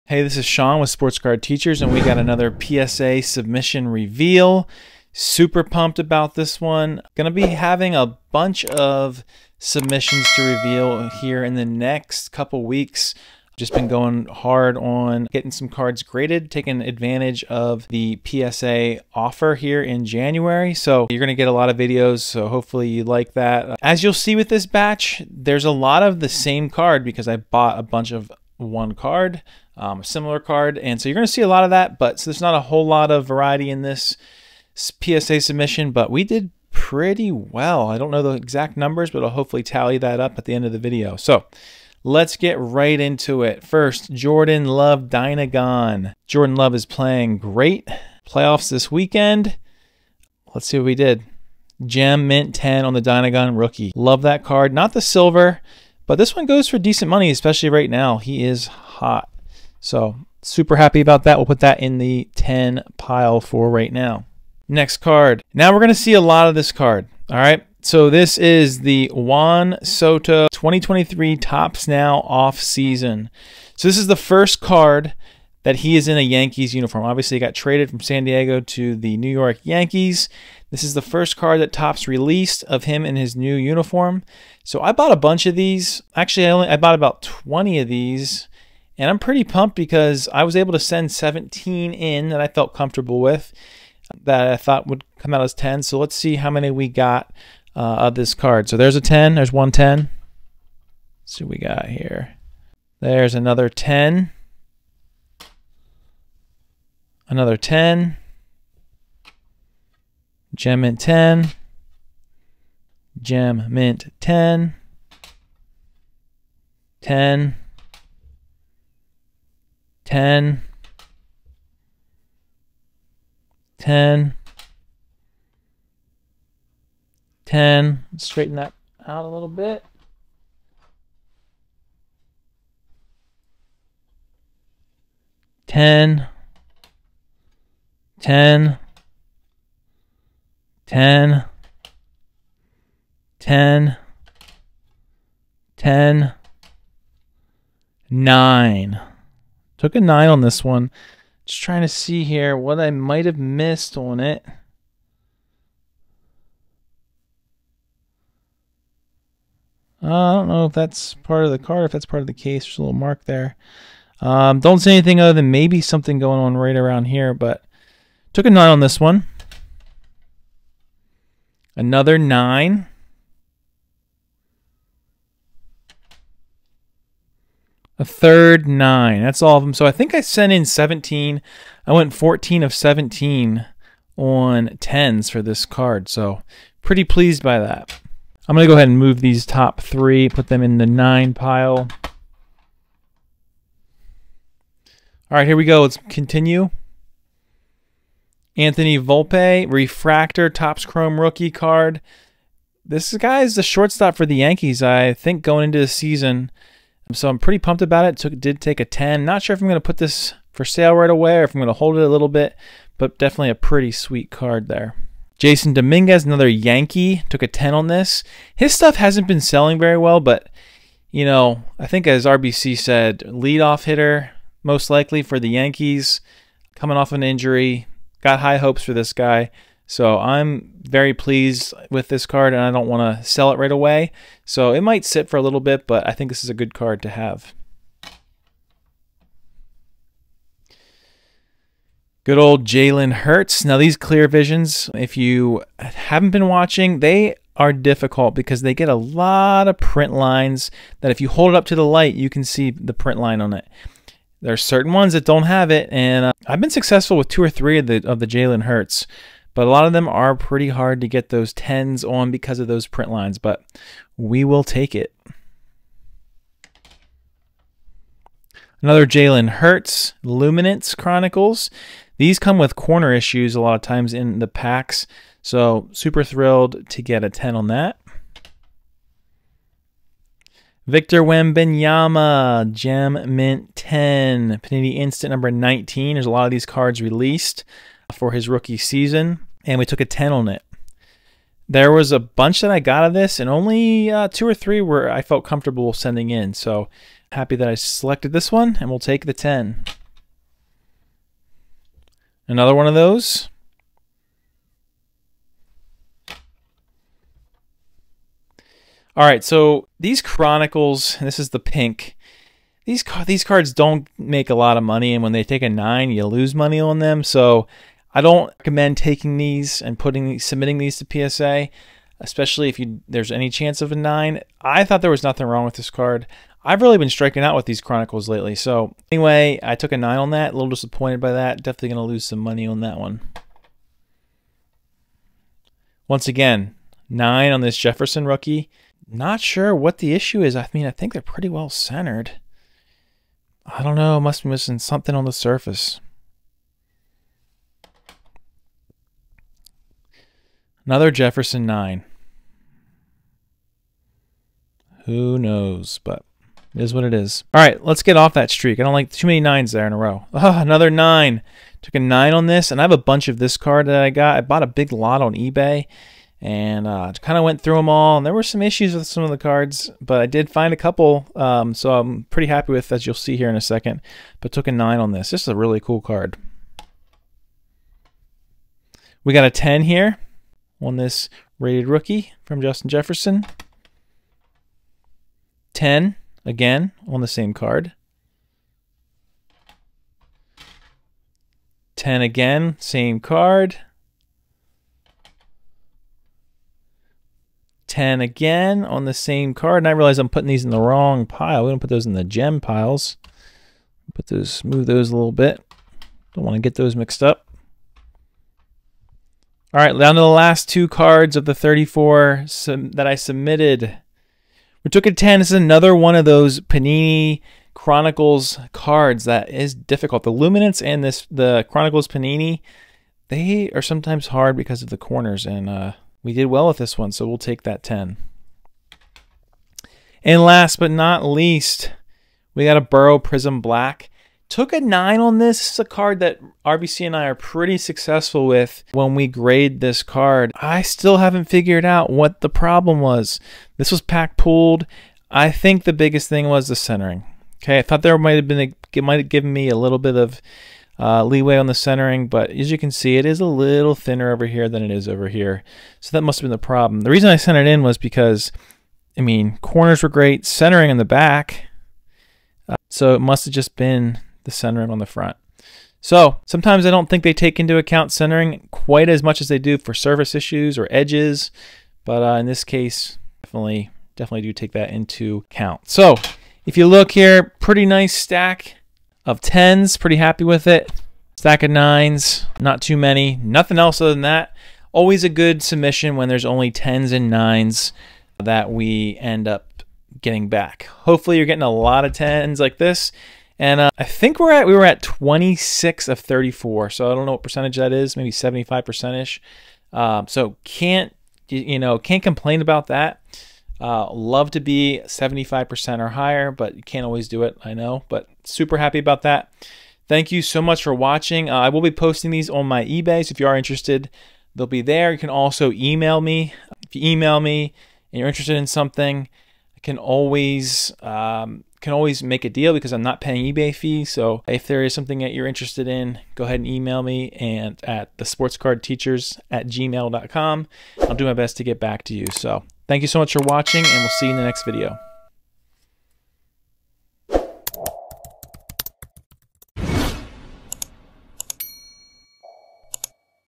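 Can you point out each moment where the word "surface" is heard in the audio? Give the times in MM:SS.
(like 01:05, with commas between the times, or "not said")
05:45, 07:49.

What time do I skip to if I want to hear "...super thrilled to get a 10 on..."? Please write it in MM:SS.
04:35.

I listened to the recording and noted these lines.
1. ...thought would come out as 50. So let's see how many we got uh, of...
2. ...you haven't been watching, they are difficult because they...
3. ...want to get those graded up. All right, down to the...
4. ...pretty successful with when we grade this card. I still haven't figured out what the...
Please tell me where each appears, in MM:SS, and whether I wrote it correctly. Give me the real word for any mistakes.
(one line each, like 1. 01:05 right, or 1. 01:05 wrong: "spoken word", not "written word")
1. 01:34 wrong: "10", not "50"
2. 04:05 right
3. 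06:46 wrong: "mixed", not "graded"
4. 07:17 right.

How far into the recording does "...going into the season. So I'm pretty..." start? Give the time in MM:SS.
03:25.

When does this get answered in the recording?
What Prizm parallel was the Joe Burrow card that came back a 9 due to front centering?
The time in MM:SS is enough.
07:13.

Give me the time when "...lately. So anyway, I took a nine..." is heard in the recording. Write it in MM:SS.
05:28.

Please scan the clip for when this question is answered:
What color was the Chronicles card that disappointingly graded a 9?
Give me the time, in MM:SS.
05:11.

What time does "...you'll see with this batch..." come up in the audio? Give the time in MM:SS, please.
00:24.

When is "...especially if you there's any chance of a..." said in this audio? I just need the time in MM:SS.
05:22.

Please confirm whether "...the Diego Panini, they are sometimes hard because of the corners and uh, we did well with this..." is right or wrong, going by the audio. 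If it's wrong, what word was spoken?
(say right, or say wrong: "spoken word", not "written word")
wrong: "Chronicles", not "Diego".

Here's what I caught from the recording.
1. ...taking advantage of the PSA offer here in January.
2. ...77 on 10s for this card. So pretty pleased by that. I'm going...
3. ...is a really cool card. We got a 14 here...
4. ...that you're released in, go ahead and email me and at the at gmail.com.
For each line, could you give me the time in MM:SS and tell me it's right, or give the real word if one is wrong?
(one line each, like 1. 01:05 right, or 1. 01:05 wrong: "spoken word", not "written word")
1. 00:16 right
2. 03:02 wrong: "17", not "77"
3. 06:15 wrong: "10", not "14"
4. 08:45 wrong: "interested", not "released".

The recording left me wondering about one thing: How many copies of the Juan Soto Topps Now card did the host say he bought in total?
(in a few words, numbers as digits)
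20.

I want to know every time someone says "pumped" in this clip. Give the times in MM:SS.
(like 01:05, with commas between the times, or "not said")
00:05, 01:29, 03:27.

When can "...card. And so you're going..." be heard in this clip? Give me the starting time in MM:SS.
00:30.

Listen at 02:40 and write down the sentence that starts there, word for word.
Uh, I don't know if that's part of the card, if that's part of the case.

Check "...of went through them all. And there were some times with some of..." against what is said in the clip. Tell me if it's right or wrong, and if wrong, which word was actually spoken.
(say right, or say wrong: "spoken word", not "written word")
wrong: "issues", not "times".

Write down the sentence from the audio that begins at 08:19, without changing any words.
Um, uh, so can't you know can't complain about that.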